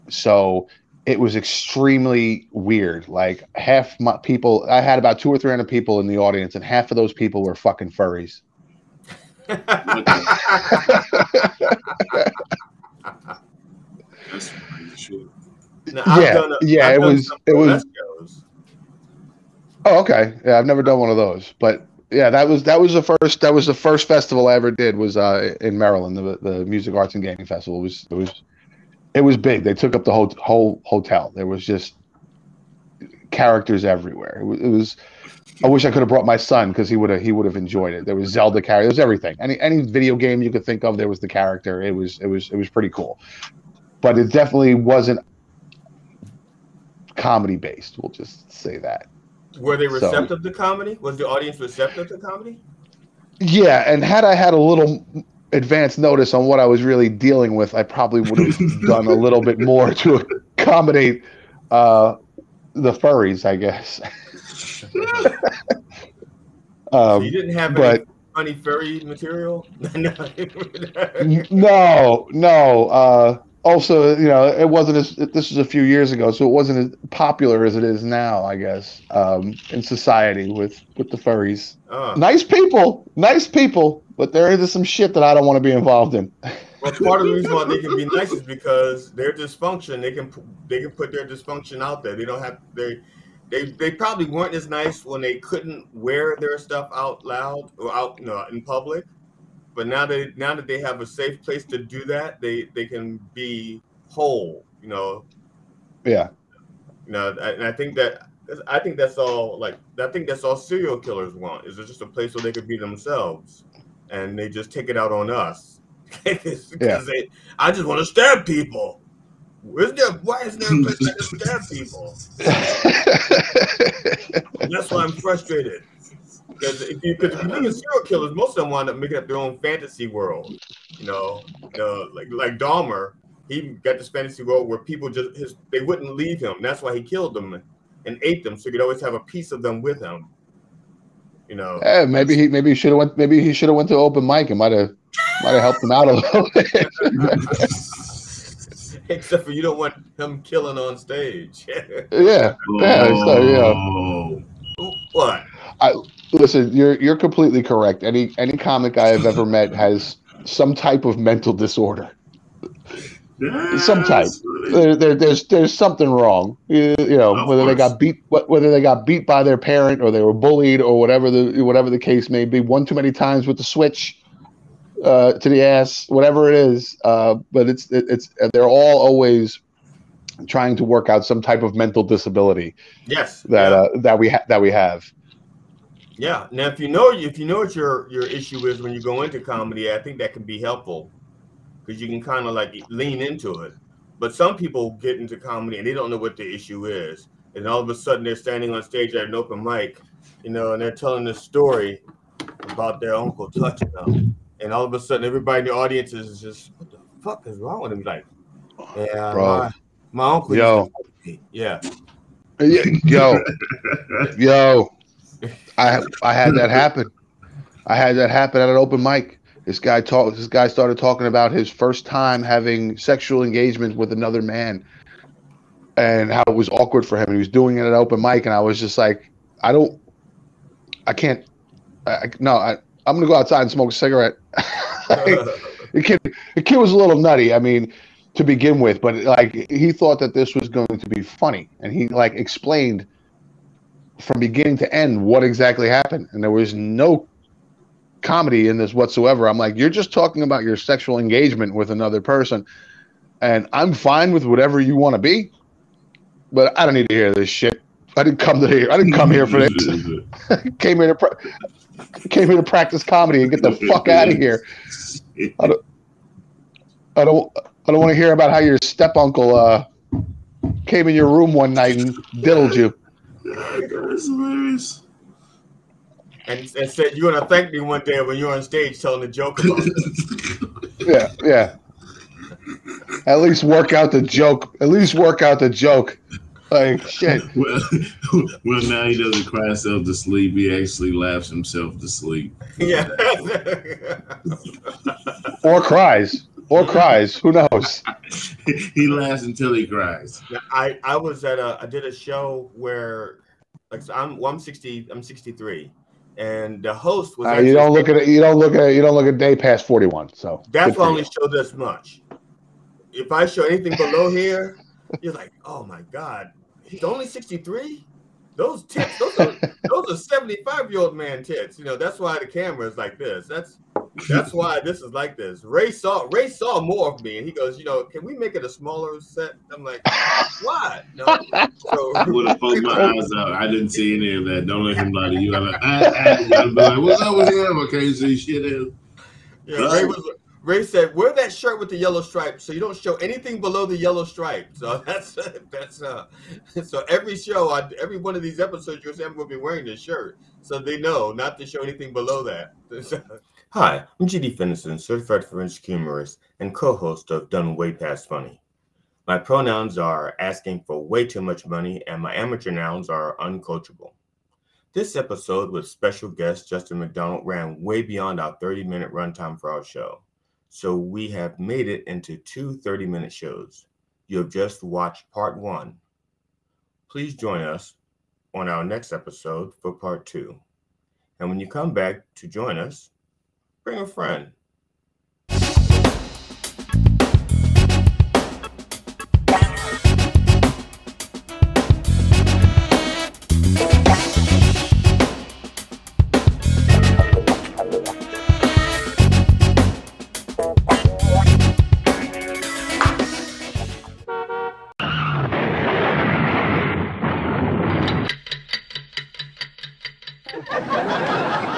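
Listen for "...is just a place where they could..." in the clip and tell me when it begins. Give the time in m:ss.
1:51.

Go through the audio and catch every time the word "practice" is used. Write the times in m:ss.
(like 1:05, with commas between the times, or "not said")
4:22.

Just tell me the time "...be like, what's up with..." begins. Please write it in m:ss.
5:36.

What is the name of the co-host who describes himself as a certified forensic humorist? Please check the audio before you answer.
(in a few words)
GD Fenderson.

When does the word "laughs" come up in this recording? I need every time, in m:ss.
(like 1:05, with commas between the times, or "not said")
4:51, 4:59.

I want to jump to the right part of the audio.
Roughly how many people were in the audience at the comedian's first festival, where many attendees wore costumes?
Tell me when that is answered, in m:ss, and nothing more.
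0:05.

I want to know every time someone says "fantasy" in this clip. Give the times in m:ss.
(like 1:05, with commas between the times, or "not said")
2:09, 2:14.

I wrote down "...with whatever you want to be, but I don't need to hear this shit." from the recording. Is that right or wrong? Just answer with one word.
right.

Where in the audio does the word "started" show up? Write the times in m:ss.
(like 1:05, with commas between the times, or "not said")
3:40.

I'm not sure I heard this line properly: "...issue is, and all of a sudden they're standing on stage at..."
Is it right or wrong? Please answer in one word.
right.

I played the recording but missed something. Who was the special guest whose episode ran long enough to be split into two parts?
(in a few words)
Justin McDonald.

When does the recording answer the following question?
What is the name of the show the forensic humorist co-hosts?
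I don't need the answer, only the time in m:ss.
5:57.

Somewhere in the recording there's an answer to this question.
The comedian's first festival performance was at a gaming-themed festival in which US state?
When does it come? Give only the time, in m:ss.
0:25.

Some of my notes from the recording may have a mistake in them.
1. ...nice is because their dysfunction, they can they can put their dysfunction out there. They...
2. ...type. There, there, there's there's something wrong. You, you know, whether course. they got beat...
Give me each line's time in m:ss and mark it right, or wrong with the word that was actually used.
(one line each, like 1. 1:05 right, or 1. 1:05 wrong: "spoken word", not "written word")
1. 1:28 right
2. 2:44 right.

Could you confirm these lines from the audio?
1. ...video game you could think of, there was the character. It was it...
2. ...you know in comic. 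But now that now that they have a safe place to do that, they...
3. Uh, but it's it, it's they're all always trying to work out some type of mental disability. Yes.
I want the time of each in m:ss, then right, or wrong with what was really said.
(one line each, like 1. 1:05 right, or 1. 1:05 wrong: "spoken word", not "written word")
1. 0:39 right
2. 1:38 wrong: "public", not "comic"
3. 2:57 right.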